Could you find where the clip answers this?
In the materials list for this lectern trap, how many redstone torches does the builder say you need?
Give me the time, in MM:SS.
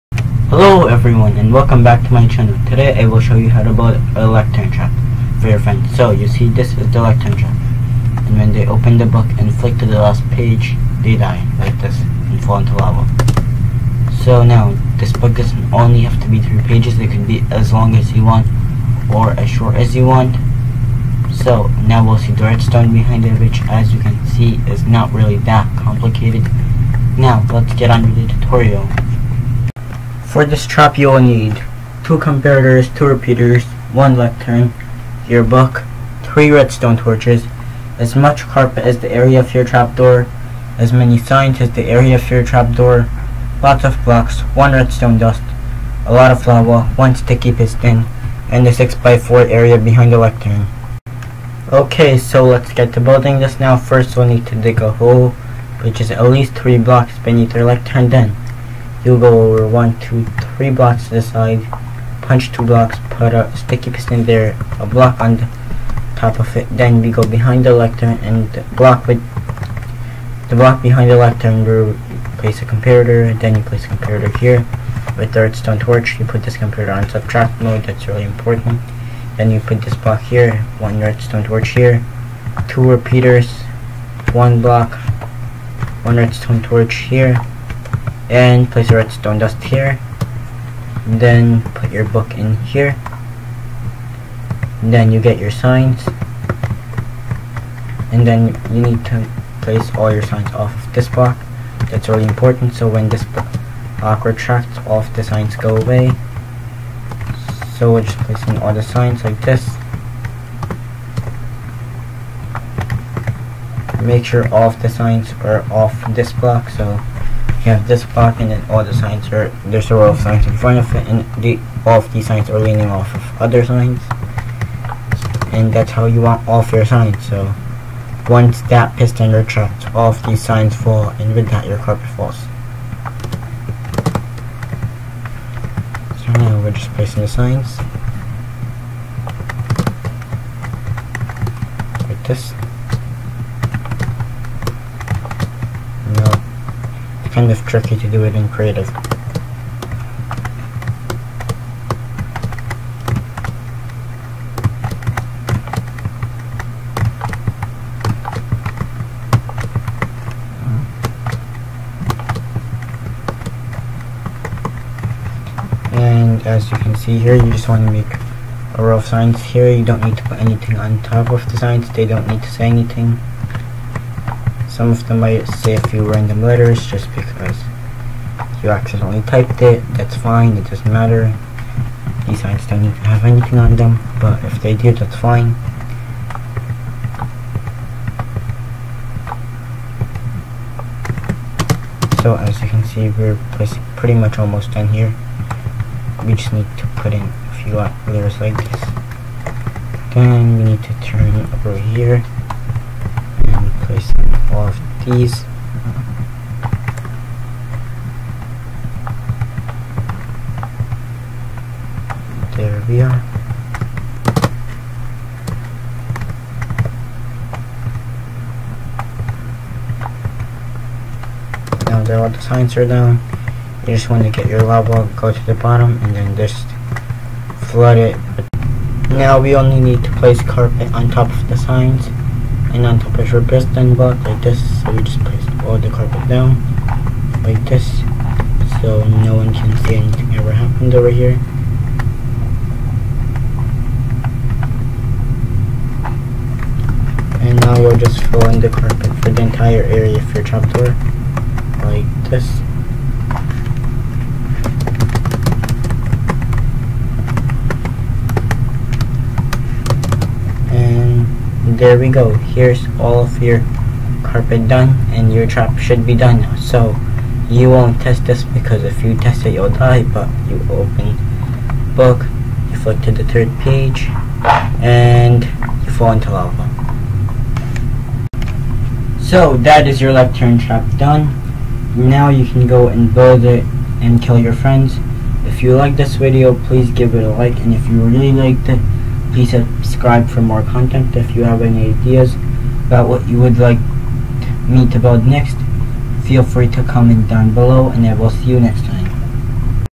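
00:36.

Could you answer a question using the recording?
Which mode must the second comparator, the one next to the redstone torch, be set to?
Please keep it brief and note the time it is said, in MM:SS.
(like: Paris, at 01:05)
subtract mode, at 01:17.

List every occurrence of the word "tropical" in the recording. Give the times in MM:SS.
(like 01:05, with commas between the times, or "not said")
not said.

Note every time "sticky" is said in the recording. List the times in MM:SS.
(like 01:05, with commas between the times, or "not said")
00:47, 01:03.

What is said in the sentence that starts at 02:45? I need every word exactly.
And as you can see here, you just want to make a row of signs here.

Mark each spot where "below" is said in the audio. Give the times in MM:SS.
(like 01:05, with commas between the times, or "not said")
04:57.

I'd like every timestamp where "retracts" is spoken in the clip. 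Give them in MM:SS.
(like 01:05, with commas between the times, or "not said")
01:44, 02:09.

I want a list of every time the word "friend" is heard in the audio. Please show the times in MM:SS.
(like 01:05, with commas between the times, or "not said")
00:05, 04:44.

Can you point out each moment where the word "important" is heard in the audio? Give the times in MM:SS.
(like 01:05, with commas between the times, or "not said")
01:18, 01:42.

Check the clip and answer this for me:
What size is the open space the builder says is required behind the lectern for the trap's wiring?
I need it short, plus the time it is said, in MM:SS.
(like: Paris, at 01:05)
6x4, at 00:48.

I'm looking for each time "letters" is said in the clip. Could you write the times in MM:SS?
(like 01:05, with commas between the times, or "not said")
02:56, 03:17.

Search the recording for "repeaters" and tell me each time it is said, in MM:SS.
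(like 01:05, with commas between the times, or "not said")
00:33, 01:22.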